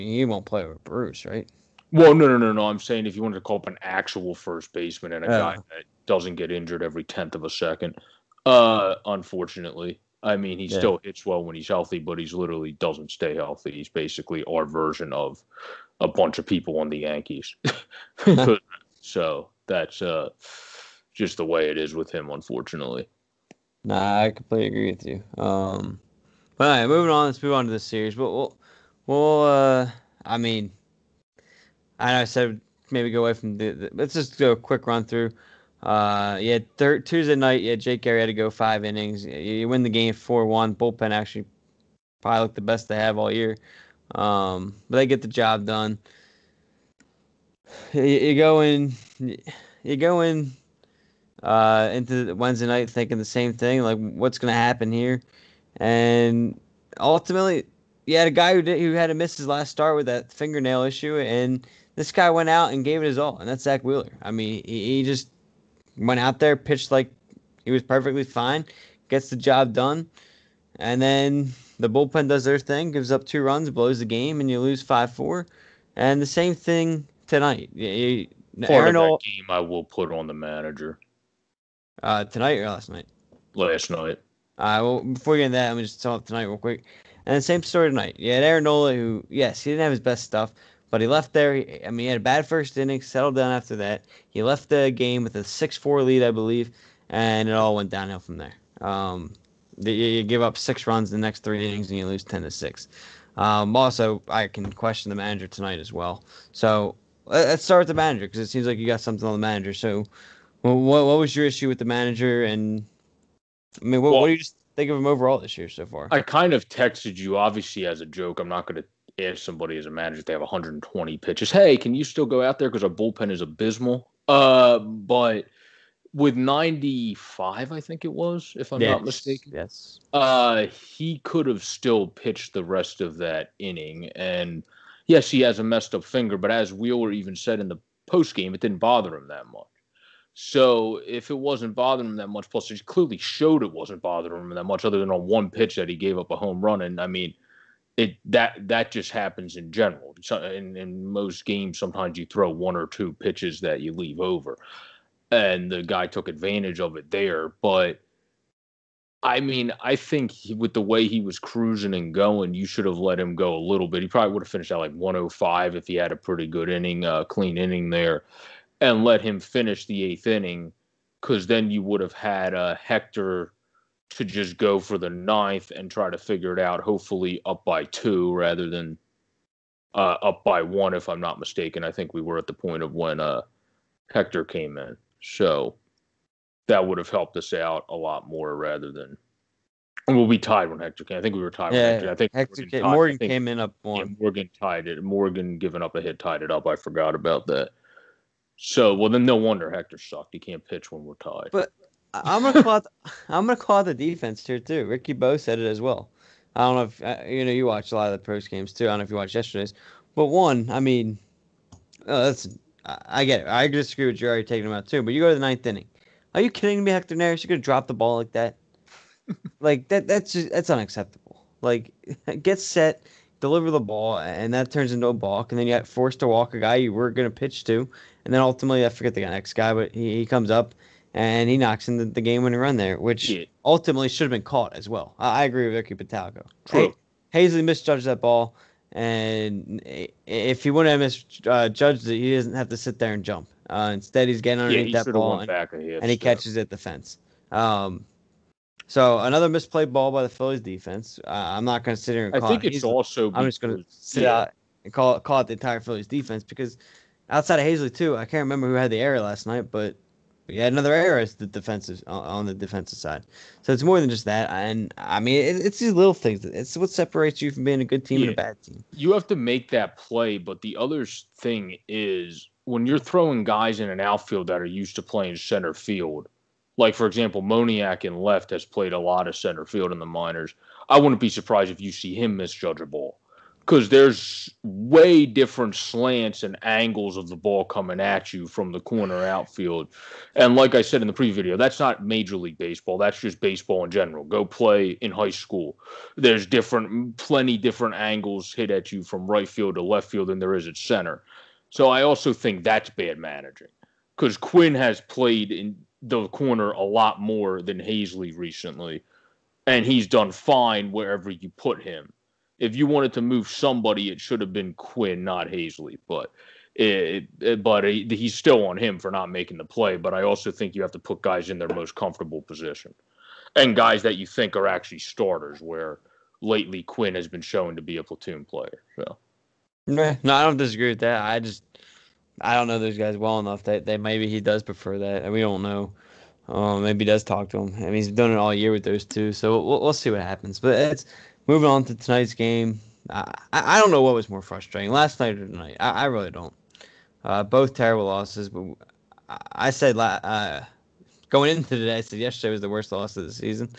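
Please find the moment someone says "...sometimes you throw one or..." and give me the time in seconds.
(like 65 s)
151 s.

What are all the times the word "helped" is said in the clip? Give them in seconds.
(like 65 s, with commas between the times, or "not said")
187 s.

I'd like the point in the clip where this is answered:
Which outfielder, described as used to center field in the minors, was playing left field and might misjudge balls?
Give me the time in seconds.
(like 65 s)
277 s.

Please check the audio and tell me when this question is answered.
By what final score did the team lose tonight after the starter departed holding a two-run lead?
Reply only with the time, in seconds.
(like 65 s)
102 s.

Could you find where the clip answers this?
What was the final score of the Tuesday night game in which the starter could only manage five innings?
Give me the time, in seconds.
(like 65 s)
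40 s.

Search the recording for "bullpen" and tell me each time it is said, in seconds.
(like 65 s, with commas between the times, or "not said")
40 s, 71 s, 122 s.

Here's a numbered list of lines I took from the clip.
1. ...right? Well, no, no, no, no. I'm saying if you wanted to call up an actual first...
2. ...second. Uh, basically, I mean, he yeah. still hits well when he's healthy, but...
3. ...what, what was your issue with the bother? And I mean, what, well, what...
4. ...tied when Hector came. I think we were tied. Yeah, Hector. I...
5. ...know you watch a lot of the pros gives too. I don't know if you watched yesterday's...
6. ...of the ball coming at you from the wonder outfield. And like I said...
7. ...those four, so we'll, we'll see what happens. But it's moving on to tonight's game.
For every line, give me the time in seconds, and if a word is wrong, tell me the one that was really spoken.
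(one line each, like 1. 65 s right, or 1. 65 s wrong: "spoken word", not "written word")
1. 1 s right
2. 7 s wrong: "unfortunately", not "basically"
3. 110 s wrong: "manager", not "bother"
4. 190 s right
5. 207 s wrong: "games", not "gives"
6. 287 s wrong: "corner", not "wonder"
7. 338 s wrong: "two", not "four".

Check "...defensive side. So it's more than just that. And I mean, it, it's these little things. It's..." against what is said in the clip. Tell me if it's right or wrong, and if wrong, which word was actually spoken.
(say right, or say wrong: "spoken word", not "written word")
right.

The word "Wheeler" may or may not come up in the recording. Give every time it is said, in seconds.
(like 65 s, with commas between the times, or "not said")
63 s, 136 s.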